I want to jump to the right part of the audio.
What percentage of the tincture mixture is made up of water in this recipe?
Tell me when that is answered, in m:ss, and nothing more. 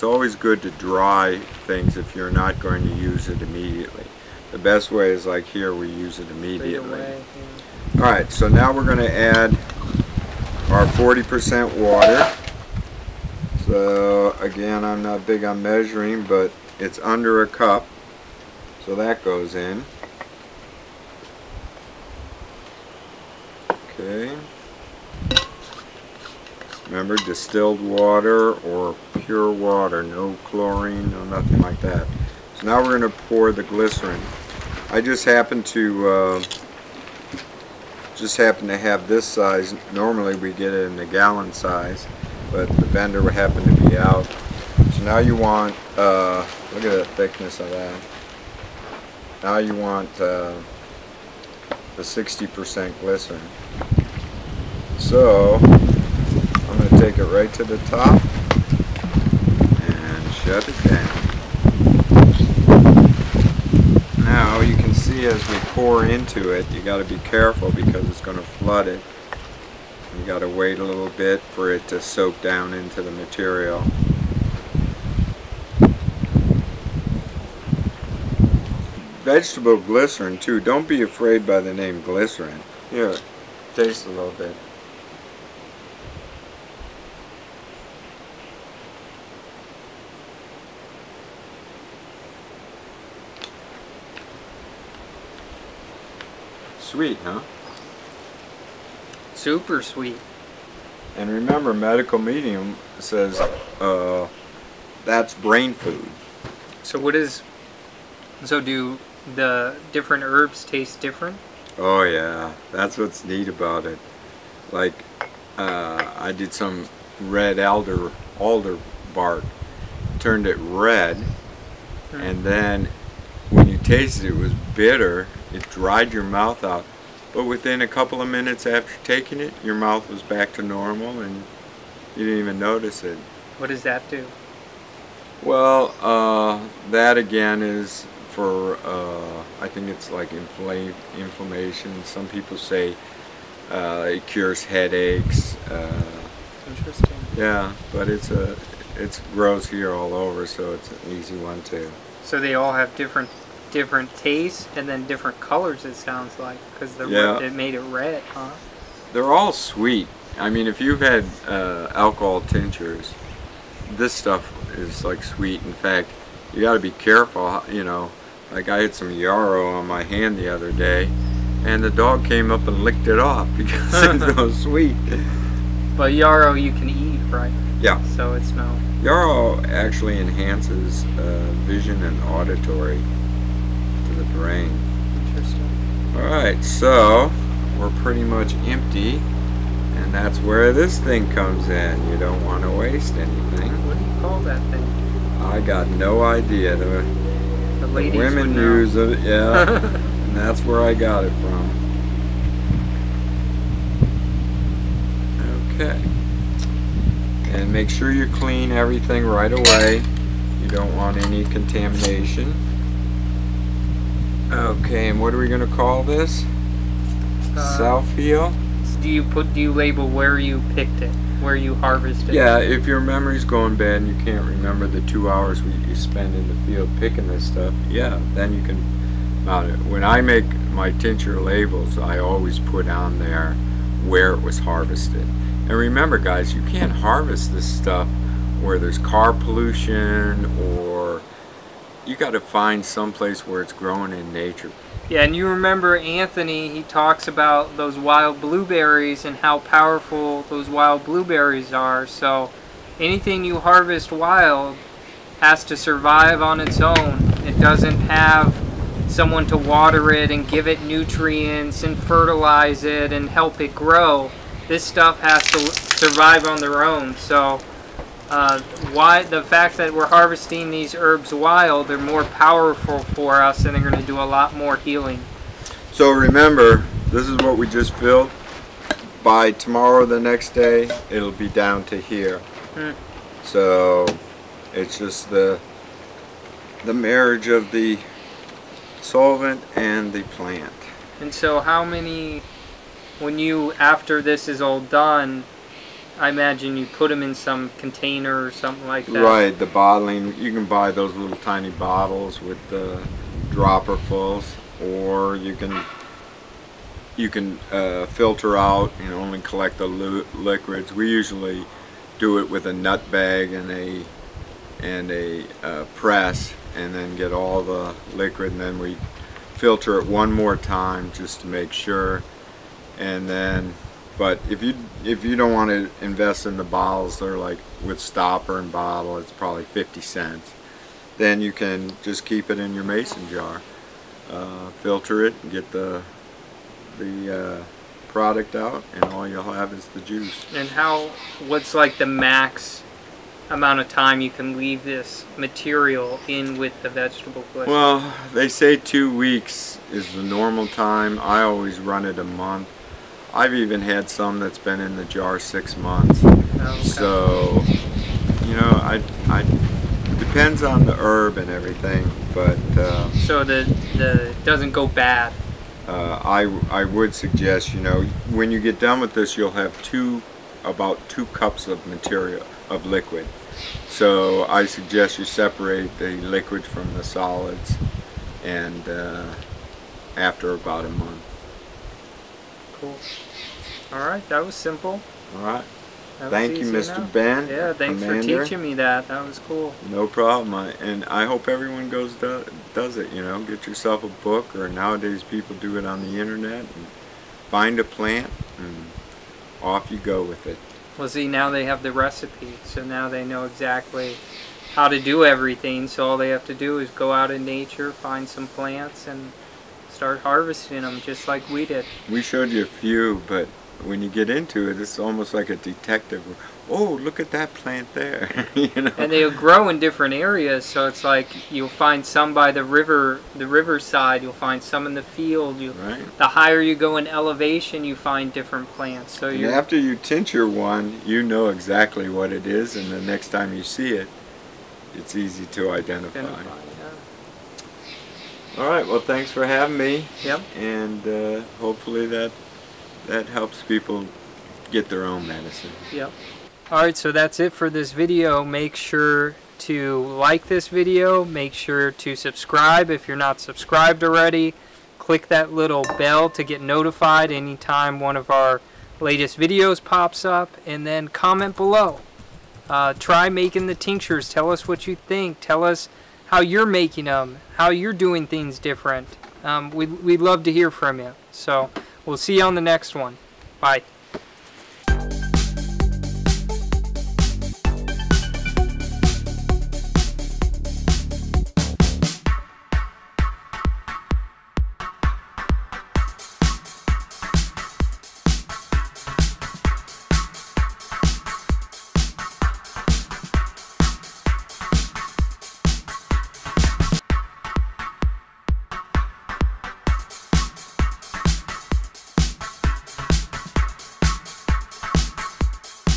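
0:10.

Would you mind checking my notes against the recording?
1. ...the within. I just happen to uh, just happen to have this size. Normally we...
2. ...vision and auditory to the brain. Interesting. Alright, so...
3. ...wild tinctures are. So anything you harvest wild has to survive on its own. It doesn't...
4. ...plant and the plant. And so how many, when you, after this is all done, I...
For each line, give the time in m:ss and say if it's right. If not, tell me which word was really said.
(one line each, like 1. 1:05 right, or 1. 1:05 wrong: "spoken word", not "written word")
1. 0:33 wrong: "glycerin", not "within"
2. 3:01 right
3. 4:10 wrong: "blueberries", not "tinctures"
4. 4:49 wrong: "solvent", not "plant".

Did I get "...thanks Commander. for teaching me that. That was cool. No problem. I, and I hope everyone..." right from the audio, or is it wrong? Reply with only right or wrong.
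right.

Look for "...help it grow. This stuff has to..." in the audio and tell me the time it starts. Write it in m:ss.
4:23.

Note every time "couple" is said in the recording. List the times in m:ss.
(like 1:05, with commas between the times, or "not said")
2:07.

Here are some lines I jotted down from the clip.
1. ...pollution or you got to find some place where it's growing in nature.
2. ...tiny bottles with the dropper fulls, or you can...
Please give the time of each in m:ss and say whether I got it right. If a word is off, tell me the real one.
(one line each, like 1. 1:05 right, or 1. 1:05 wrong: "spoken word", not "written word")
1. 3:59 right
2. 5:01 right.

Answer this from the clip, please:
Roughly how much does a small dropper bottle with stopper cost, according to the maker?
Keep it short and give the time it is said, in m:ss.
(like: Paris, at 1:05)
50 cents, at 5:29.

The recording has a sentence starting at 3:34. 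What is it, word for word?
Okay, and what are we going to call this?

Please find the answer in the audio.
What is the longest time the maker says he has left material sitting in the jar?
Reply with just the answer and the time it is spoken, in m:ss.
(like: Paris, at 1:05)
Six months, at 5:55.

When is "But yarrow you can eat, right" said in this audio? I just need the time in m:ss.
2:55.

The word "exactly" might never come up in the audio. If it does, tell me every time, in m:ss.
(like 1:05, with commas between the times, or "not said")
6:43, 7:11.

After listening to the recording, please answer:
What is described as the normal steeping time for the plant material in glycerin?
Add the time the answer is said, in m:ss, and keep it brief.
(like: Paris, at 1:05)
Two weeks, at 5:48.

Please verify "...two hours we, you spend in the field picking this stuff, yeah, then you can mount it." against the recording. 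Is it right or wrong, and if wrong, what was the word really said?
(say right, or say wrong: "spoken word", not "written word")
right.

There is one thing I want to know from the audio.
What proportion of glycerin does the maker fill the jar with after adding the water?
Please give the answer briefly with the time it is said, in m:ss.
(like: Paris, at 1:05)
60%, at 0:52.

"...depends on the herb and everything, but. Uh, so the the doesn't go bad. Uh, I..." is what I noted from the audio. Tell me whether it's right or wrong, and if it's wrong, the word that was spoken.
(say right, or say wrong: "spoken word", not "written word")
right.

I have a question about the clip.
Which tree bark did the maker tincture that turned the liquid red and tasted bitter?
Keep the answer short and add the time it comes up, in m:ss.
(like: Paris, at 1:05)
Red alder, at 1:57.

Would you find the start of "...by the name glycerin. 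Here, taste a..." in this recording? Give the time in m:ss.
1:21.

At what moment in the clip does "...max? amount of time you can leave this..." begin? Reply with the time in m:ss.
5:42.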